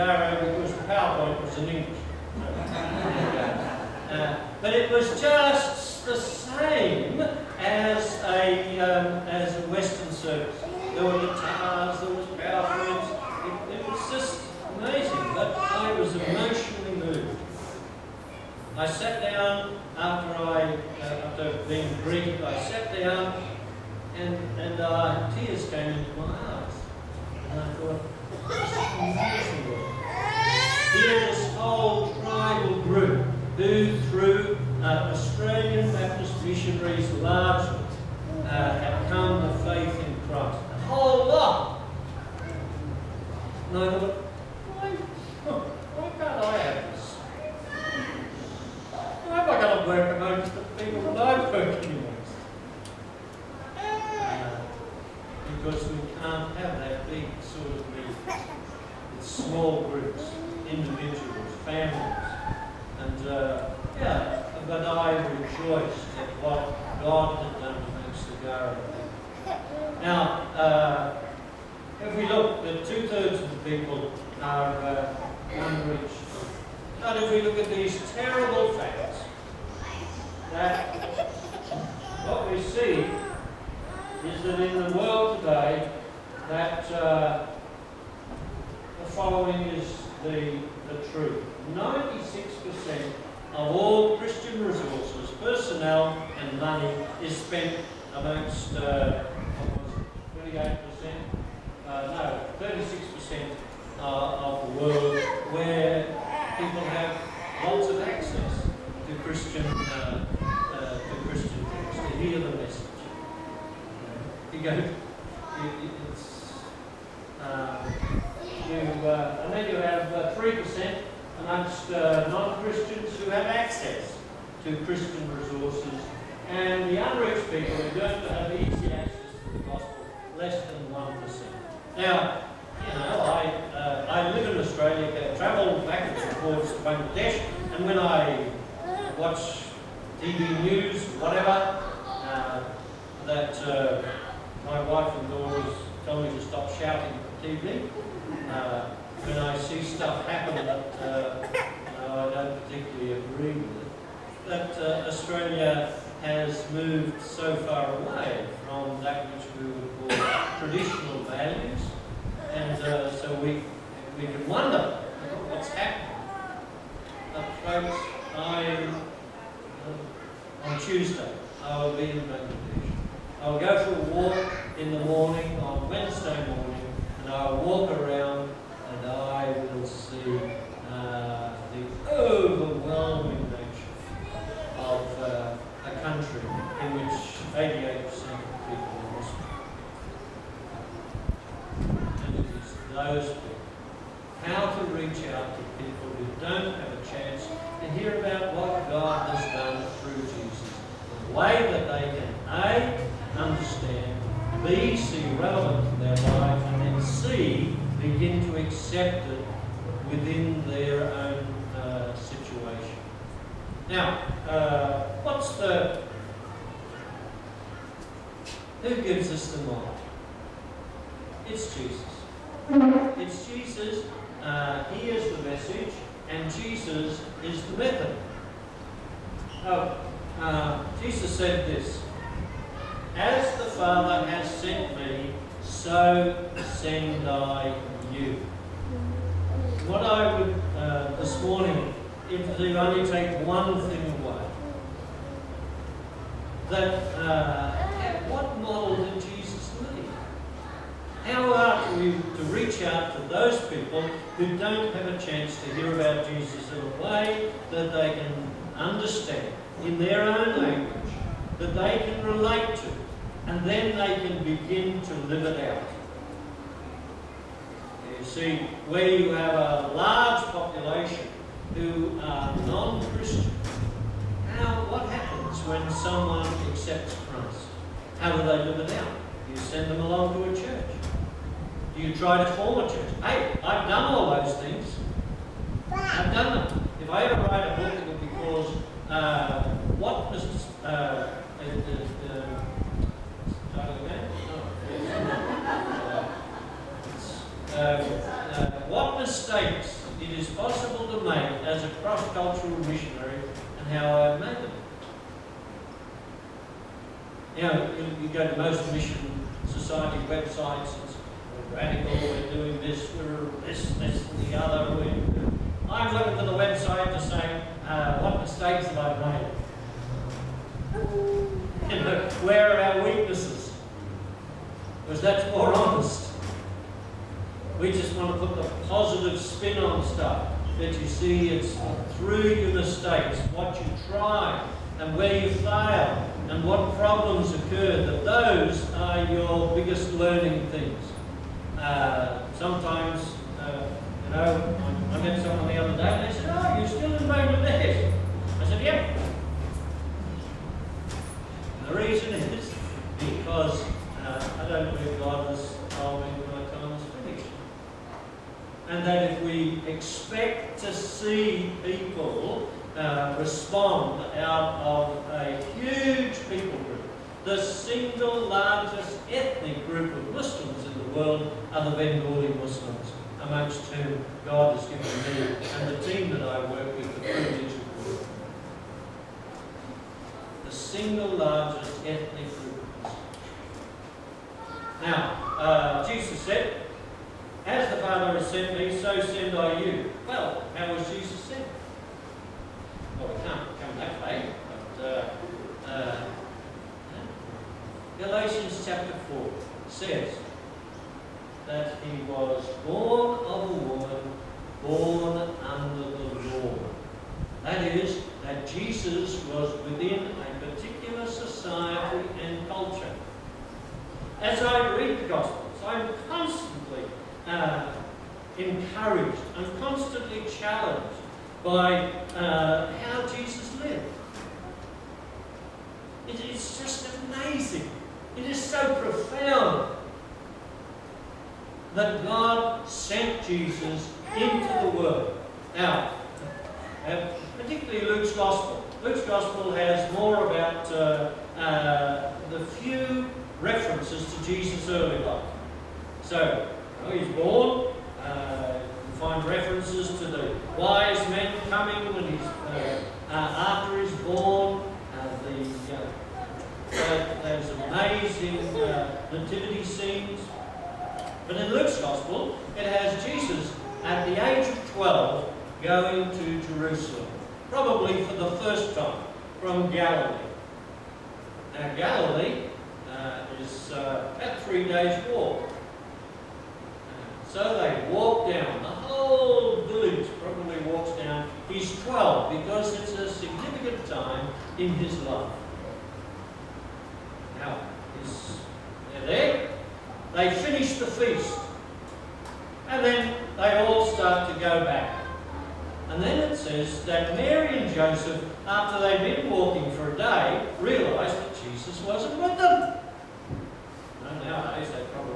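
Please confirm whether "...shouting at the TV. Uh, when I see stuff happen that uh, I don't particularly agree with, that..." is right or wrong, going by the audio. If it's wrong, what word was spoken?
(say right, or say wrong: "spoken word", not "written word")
right.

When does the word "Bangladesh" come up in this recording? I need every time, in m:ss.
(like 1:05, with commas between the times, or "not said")
2:52, 5:47.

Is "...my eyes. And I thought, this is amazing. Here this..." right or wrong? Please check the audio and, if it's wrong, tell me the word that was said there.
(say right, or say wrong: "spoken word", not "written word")
right.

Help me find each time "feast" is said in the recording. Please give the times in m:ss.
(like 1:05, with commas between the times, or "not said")
8:11.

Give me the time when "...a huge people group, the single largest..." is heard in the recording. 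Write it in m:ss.
6:05.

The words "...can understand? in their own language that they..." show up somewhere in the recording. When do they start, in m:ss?
4:18.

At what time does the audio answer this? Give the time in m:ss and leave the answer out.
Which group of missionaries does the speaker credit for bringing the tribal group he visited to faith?
0:35.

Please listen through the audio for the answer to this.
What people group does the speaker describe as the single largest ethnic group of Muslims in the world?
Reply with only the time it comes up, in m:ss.
6:11.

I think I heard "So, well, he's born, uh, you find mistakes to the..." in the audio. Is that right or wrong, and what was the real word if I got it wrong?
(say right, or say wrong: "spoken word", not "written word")
wrong: "references", not "mistakes".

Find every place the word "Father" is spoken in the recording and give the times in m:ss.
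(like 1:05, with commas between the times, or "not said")
3:53, 6:28.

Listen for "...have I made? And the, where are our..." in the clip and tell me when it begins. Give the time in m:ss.
5:18.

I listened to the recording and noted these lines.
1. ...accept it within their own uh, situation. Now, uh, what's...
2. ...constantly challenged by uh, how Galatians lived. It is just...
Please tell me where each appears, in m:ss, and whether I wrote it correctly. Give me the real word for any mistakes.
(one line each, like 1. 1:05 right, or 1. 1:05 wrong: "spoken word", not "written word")
1. 3:28 right
2. 6:59 wrong: "Jesus", not "Galatians".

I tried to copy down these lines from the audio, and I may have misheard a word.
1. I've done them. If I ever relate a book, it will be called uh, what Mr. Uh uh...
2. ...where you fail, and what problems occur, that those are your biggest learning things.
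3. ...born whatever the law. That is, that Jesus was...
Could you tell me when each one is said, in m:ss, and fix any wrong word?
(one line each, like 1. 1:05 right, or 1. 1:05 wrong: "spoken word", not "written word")
1. 4:45 wrong: "write", not "relate"
2. 5:35 right
3. 6:44 wrong: "under", not "whatever".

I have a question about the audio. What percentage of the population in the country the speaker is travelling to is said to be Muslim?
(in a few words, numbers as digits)
88%.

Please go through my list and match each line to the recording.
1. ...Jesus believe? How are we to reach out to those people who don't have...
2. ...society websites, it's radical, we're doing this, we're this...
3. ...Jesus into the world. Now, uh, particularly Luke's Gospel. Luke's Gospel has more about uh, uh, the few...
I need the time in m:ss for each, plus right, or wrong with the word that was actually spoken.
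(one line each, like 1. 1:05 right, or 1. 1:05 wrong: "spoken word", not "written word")
1. 4:09 wrong: "leave", not "believe"
2. 5:09 right
3. 7:13 right.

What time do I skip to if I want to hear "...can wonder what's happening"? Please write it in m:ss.
2:44.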